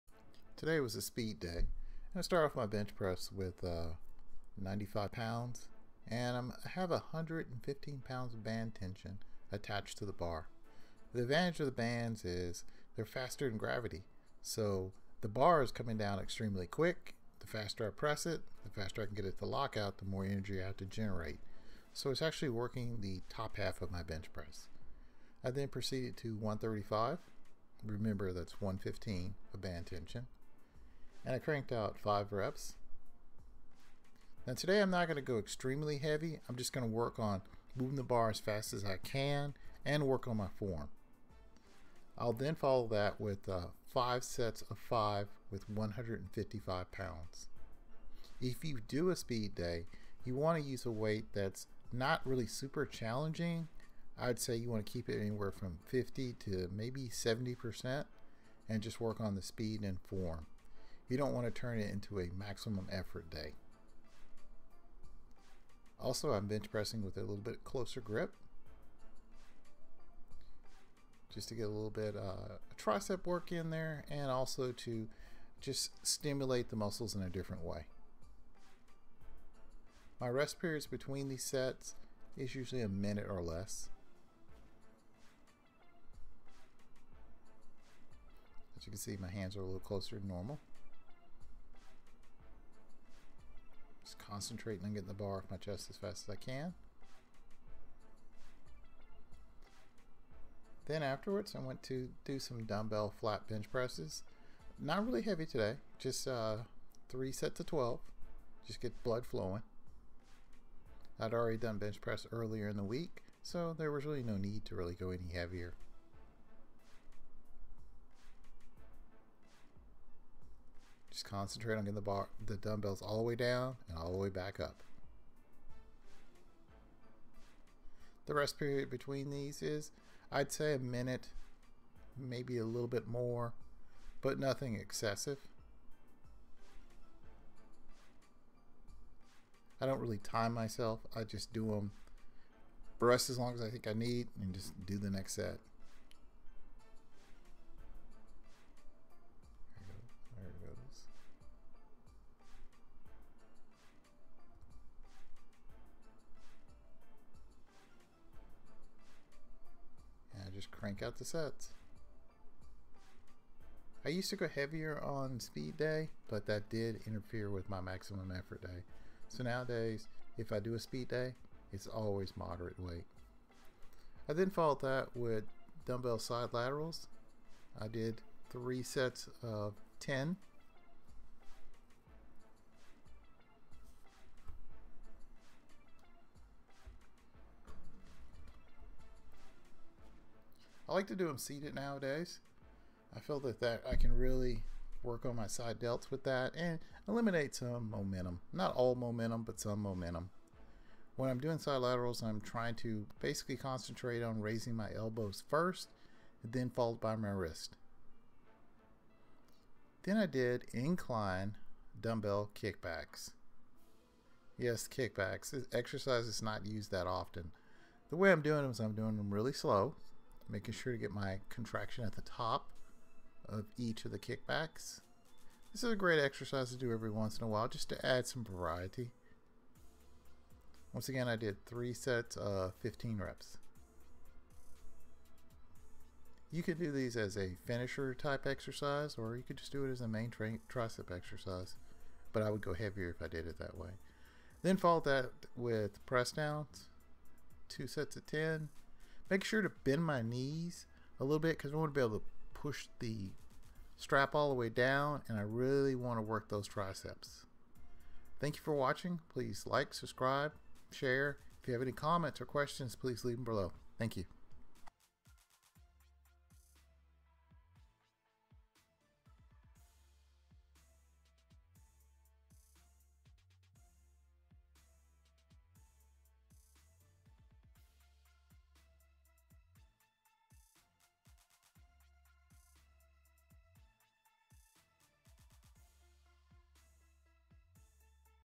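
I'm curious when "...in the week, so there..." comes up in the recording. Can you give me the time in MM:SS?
01:52.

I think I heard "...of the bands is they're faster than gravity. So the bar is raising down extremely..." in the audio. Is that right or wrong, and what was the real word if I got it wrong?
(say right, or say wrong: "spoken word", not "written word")
wrong: "coming", not "raising".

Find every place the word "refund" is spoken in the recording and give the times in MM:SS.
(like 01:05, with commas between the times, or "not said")
not said.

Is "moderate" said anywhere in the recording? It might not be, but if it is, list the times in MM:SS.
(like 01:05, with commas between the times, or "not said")
02:52.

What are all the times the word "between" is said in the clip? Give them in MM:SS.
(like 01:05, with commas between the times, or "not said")
01:20, 02:08.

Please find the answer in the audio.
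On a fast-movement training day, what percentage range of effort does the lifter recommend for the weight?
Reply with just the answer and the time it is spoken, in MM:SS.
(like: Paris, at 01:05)
50 to 70%, at 00:55.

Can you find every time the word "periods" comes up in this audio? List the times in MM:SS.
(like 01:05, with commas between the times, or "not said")
01:20, 02:08.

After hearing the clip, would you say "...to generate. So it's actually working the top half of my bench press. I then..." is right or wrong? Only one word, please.
right.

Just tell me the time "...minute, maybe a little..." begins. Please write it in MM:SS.
02:10.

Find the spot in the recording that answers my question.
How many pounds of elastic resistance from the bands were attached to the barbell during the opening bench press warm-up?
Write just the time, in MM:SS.
00:06.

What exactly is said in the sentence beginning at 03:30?
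Then I did incline dumbbell kickbacks.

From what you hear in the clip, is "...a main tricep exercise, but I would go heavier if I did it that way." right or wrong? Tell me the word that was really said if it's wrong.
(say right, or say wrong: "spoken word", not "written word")
right.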